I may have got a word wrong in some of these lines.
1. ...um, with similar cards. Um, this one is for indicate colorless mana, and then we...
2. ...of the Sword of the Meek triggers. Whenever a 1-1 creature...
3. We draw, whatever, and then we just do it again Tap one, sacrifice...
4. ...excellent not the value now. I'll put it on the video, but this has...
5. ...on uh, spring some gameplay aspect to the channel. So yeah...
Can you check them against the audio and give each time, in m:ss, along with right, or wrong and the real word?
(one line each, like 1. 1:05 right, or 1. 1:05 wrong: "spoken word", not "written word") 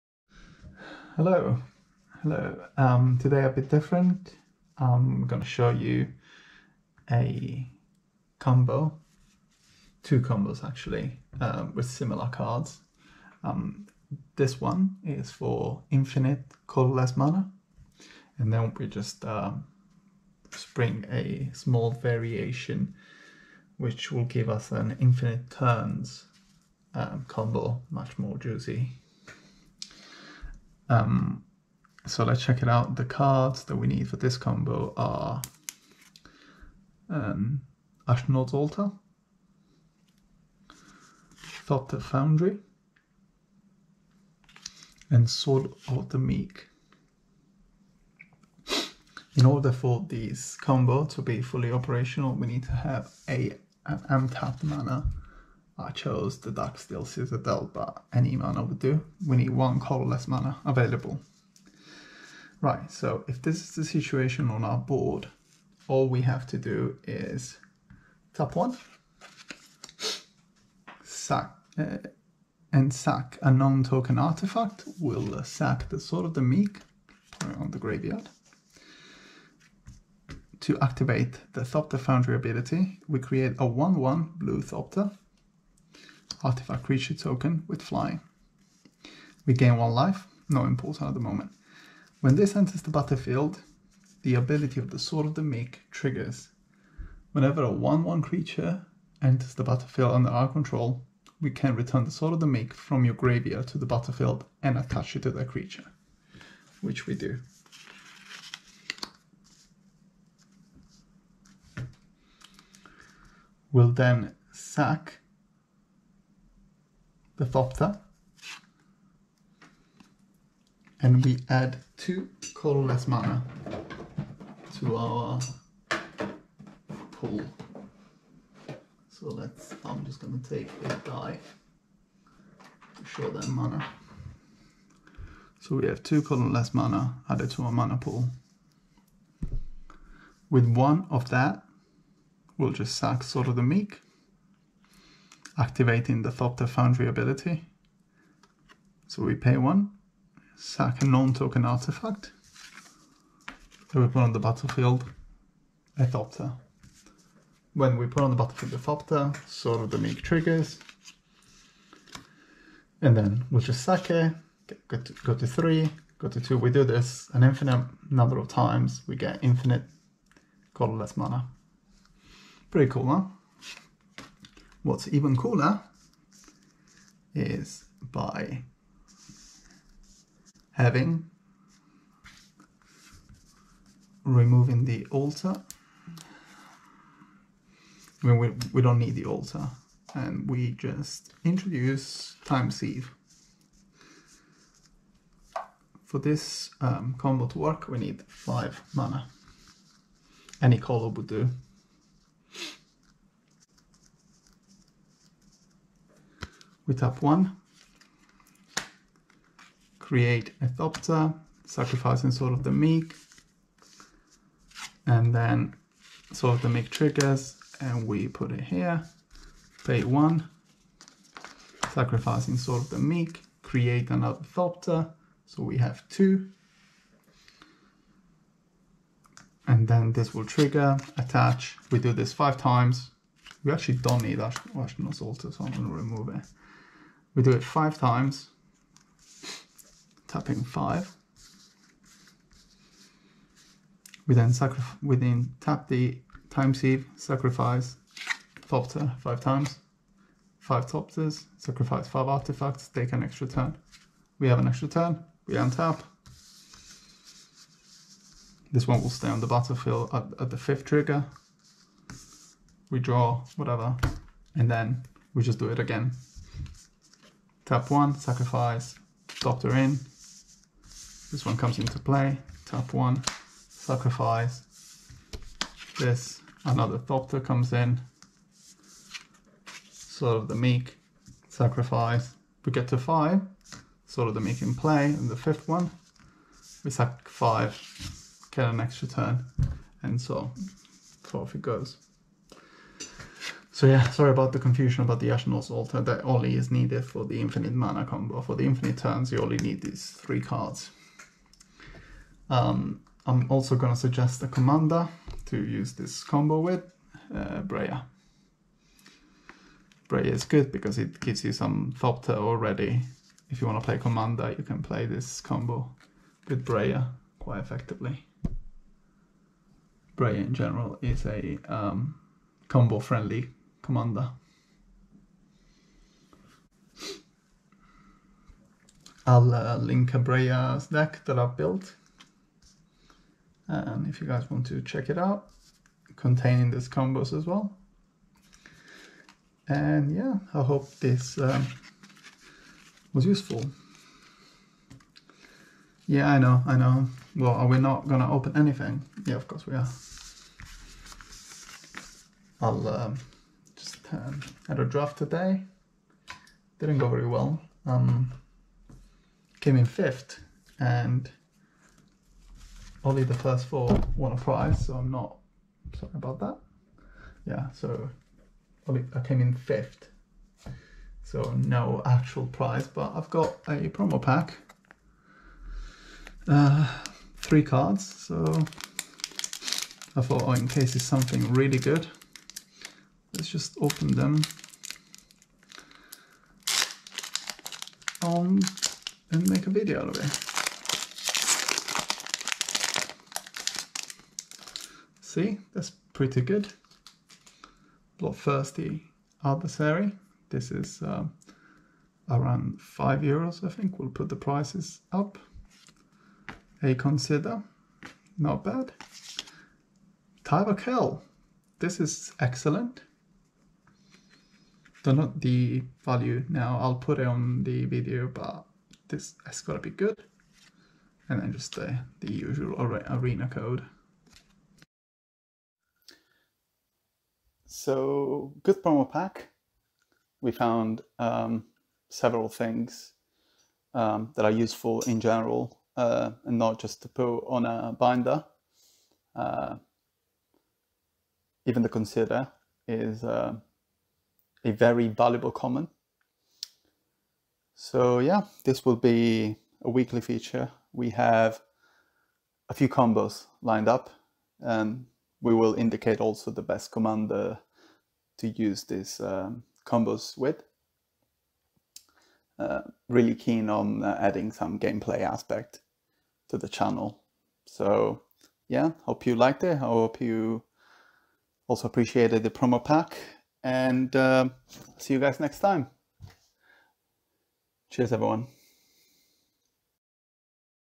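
1. 0:11 wrong: "infinite", not "indicate"
2. 1:34 right
3. 4:22 right
4. 6:52 right
5. 7:43 wrong: "adding", not "spring".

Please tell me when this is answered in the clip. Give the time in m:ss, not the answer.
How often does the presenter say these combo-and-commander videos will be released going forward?
7:29.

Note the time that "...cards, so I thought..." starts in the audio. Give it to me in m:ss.
6:17.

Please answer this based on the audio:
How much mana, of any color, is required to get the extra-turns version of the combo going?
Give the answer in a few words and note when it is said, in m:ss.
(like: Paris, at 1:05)
5, at 3:18.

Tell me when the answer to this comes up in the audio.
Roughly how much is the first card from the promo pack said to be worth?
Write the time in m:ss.
6:42.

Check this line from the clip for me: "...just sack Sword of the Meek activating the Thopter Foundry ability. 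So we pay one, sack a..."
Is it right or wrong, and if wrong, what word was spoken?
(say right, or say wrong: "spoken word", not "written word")
right.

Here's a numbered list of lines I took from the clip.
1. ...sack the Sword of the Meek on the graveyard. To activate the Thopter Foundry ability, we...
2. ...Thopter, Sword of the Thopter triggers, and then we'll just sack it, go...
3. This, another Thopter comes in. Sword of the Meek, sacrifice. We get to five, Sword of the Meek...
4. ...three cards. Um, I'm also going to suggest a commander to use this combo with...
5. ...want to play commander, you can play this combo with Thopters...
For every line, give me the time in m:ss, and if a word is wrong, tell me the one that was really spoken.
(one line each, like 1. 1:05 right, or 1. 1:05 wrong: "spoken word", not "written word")
1. 1:15 right
2. 2:38 wrong: "Meek", not "Thopter"
3. 4:35 right
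4. 5:00 right
5. 5:13 wrong: "Breya", not "Thopters".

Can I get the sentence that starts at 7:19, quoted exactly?
Uh, even the consider is uh, a very valuable comment.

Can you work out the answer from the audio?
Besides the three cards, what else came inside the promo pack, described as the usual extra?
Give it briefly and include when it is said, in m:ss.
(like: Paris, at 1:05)
Arena code, at 7:02.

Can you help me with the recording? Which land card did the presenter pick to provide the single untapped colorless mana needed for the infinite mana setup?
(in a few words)
Darksteel Citadel.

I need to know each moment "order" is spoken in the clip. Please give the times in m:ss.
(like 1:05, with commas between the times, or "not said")
0:49.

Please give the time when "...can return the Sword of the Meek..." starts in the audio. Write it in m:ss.
1:41.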